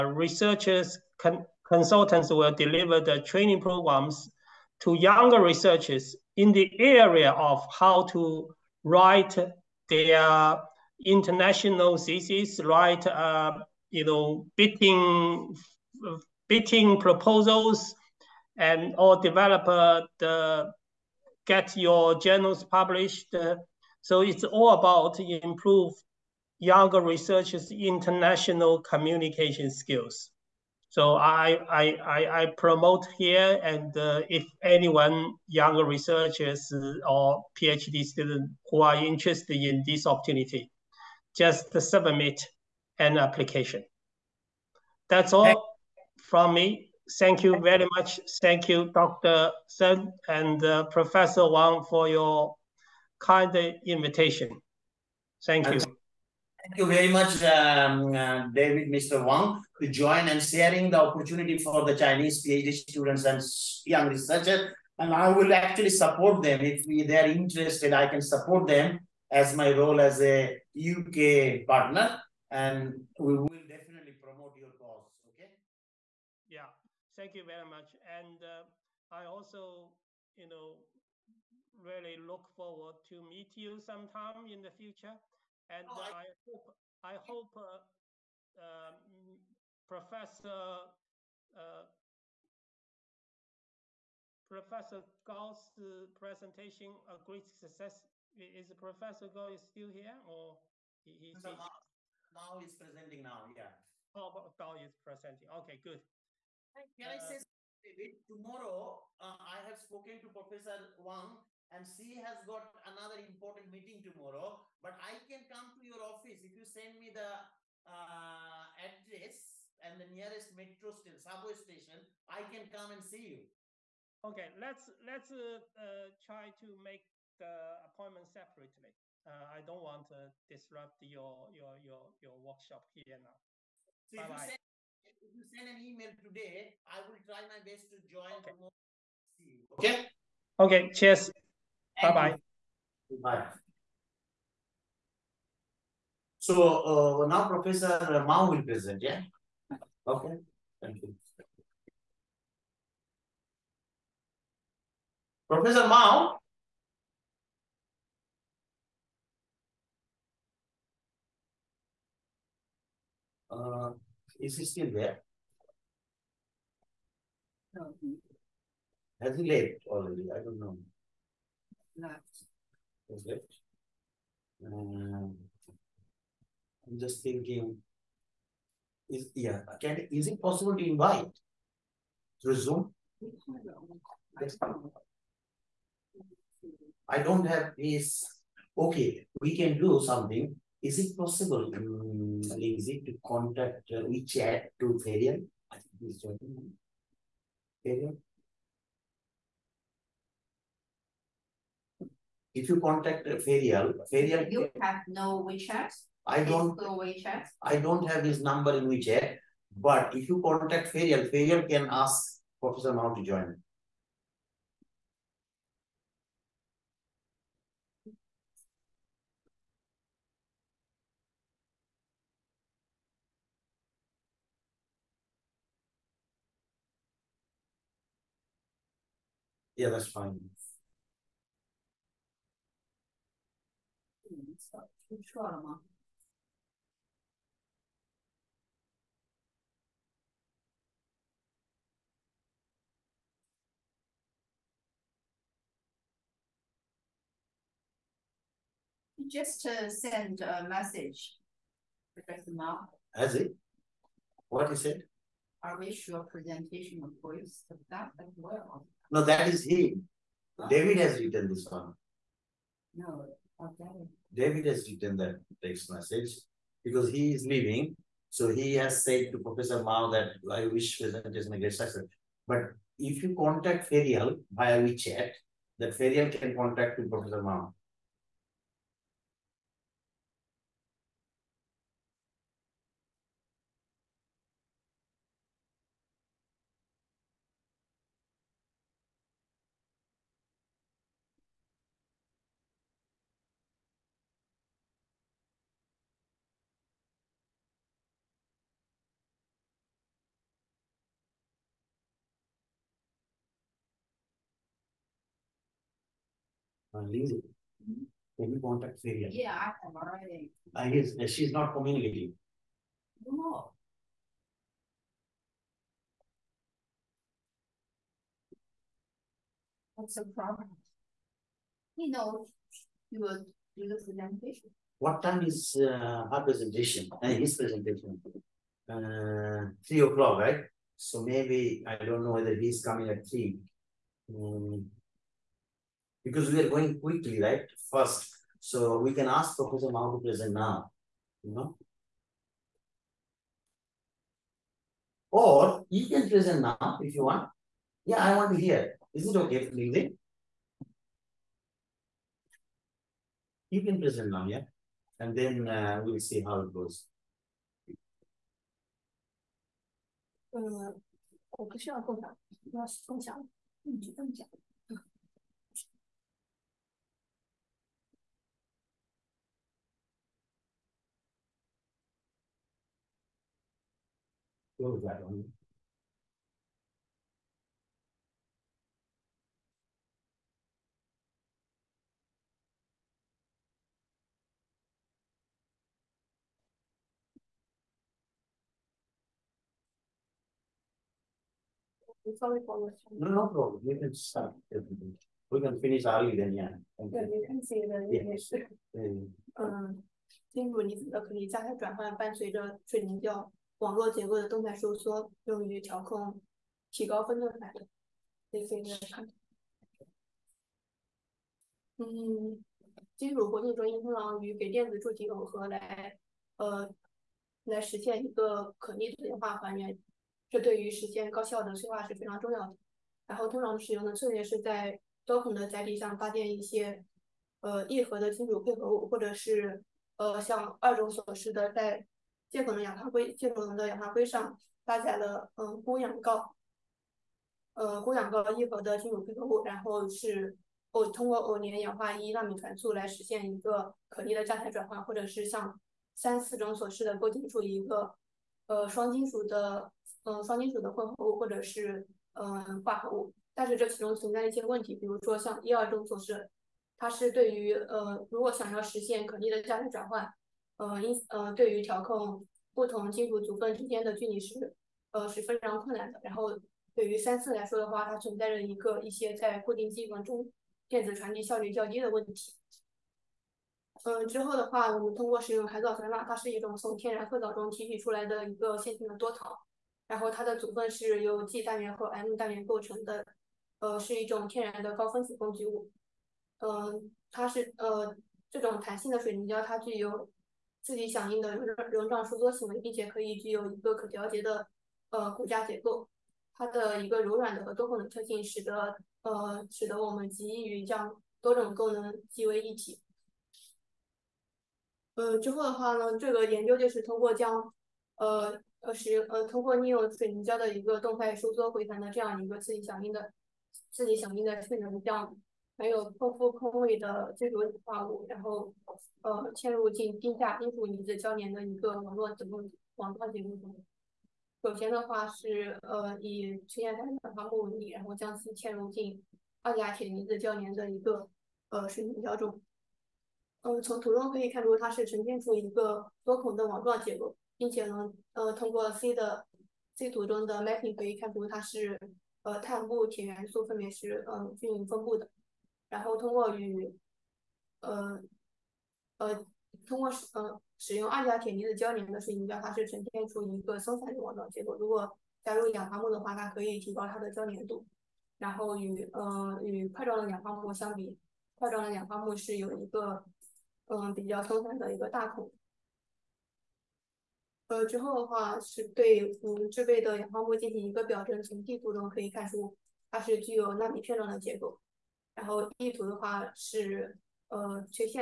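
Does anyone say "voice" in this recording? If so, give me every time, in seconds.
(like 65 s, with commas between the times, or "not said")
257 s.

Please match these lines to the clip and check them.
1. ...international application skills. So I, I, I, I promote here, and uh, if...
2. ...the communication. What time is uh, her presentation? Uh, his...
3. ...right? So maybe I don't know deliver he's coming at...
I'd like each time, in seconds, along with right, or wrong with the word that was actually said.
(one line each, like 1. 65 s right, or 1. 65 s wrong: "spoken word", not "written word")
1. 27 s wrong: "communication", not "application"
2. 323 s wrong: "presentation", not "communication"
3. 330 s wrong: "whether", not "deliver".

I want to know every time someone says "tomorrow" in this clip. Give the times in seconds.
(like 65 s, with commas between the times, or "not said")
108 s, 114 s, 138 s.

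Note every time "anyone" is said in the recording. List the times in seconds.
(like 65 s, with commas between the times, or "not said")
34 s.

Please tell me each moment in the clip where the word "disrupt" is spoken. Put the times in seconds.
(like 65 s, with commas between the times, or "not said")
130 s.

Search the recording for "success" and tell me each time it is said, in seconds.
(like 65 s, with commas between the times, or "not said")
97 s, 271 s.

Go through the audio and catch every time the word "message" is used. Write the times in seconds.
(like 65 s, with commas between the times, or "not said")
250 s, 265 s.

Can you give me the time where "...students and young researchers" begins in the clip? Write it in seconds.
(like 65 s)
62 s.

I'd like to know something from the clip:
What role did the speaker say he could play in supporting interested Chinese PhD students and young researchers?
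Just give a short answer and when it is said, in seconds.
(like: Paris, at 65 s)
UK partner, at 70 s.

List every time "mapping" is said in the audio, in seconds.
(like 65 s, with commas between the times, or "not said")
540 s.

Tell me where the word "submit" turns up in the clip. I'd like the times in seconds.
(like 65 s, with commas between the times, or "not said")
41 s.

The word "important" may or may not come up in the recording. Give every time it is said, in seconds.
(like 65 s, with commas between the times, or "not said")
113 s.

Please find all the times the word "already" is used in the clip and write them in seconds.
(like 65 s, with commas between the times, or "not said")
169 s, 309 s.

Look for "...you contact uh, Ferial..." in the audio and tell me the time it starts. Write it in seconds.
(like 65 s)
202 s.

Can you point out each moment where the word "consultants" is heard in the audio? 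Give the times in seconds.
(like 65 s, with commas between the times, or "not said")
1 s.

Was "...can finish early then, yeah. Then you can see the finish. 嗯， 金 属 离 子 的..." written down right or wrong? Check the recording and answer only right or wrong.
right.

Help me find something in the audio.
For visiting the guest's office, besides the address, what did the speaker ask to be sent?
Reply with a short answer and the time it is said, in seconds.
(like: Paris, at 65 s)
nearest metro station, at 120 s.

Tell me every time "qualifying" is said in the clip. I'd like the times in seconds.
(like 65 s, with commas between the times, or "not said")
not said.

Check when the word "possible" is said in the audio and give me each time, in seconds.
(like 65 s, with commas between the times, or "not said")
180 s, 191 s.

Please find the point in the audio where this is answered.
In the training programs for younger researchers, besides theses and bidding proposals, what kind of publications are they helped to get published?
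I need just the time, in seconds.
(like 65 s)
22 s.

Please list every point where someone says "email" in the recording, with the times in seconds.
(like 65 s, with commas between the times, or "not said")
135 s.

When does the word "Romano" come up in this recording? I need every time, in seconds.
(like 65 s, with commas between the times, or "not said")
not said.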